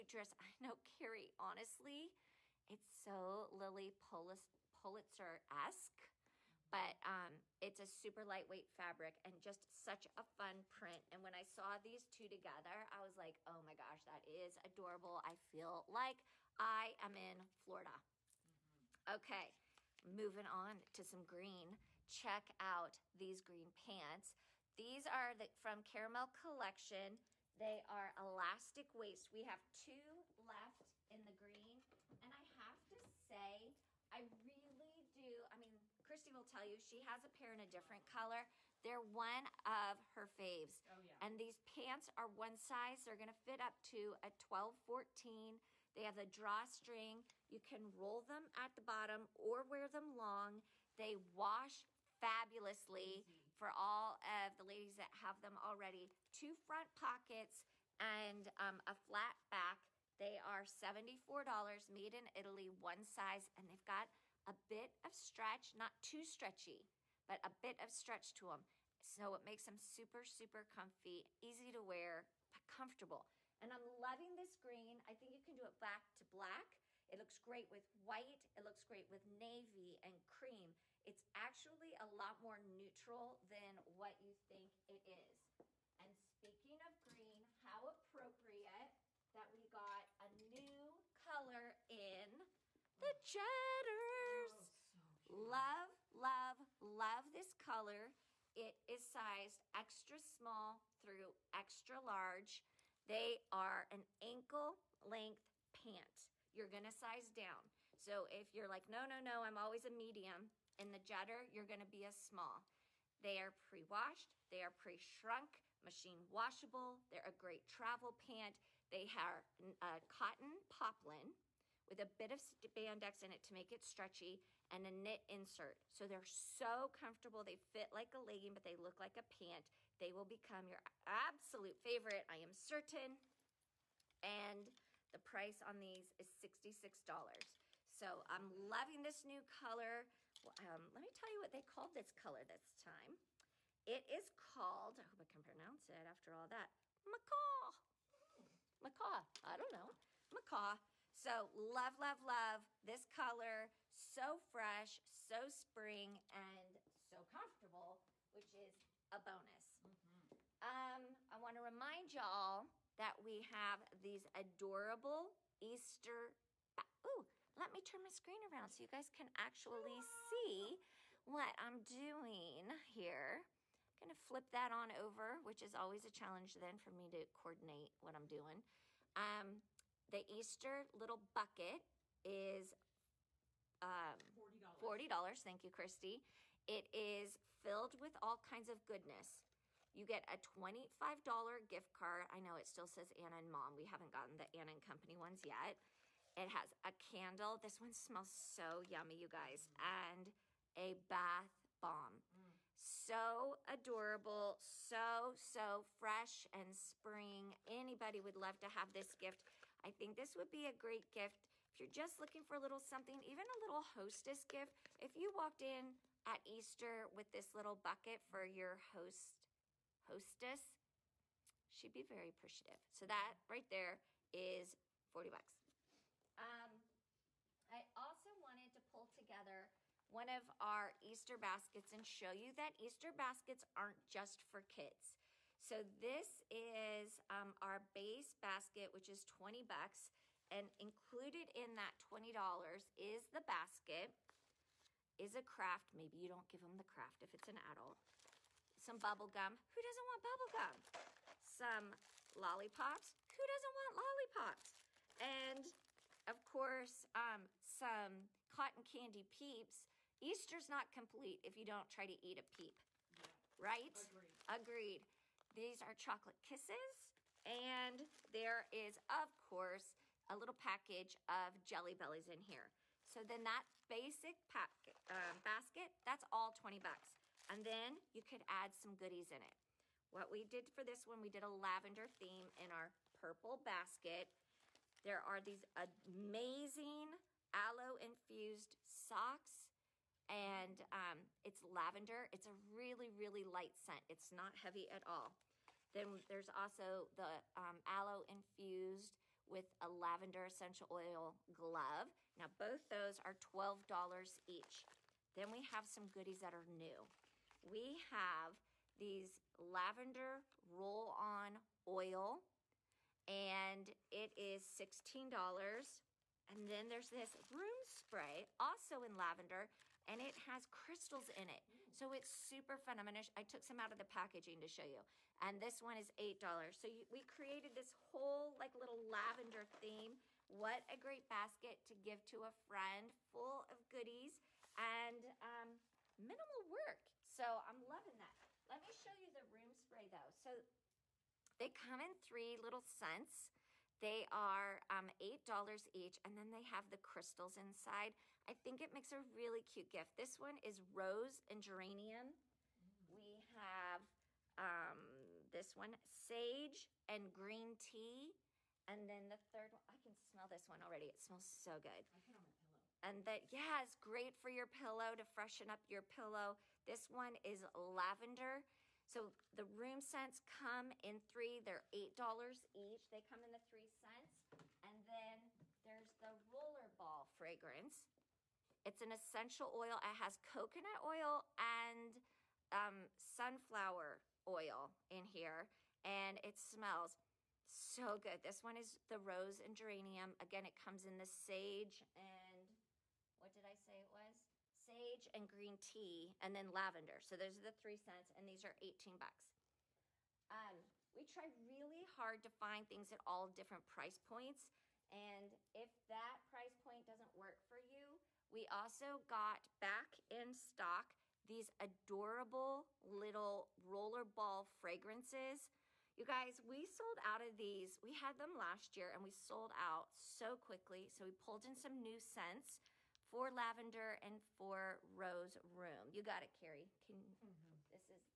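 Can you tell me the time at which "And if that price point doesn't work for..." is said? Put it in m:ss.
6:45.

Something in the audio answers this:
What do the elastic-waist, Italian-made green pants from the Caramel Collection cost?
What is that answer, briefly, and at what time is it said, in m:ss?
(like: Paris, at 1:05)
$74, at 1:00.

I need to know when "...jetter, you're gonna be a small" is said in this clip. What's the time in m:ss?
1:50.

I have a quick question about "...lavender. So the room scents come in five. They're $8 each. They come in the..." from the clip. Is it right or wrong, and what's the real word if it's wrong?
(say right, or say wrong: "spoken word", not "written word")
wrong: "three", not "five".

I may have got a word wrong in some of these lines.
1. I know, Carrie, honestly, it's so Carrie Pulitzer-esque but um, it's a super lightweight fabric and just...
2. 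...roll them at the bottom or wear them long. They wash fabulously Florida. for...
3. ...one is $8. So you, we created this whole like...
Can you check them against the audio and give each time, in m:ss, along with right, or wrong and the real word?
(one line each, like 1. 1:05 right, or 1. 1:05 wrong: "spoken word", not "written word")
1. 0:00 wrong: "Lilly", not "Carrie"
2. 0:47 wrong: "Easy", not "Florida"
3. 5:25 right.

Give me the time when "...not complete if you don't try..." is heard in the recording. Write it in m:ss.
4:20.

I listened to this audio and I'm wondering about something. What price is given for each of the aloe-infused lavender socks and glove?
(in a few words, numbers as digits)
$12.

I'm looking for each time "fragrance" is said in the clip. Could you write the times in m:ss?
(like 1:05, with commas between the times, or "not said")
6:17, 6:54.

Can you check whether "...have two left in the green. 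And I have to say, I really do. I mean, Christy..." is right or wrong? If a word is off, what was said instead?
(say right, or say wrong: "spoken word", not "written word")
right.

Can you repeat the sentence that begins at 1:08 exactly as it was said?
So it makes them super, super comfy, easy to wear, but comfortable.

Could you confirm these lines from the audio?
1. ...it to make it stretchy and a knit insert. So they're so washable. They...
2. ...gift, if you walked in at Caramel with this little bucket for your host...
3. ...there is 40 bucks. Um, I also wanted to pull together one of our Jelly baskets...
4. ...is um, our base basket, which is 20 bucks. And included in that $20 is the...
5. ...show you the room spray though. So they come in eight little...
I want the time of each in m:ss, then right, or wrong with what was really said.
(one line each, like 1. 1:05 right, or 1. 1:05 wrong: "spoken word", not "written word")
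1. 2:03 wrong: "comfortable", not "washable"
2. 3:34 wrong: "Easter", not "Caramel"
3. 3:43 wrong: "Easter", not "Jelly"
4. 3:56 right
5. 5:38 wrong: "three", not "eight".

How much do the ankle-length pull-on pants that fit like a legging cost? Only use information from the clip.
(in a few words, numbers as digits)
$66.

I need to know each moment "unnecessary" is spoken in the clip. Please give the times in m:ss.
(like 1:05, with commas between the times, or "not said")
not said.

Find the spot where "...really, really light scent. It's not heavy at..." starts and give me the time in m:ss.
4:52.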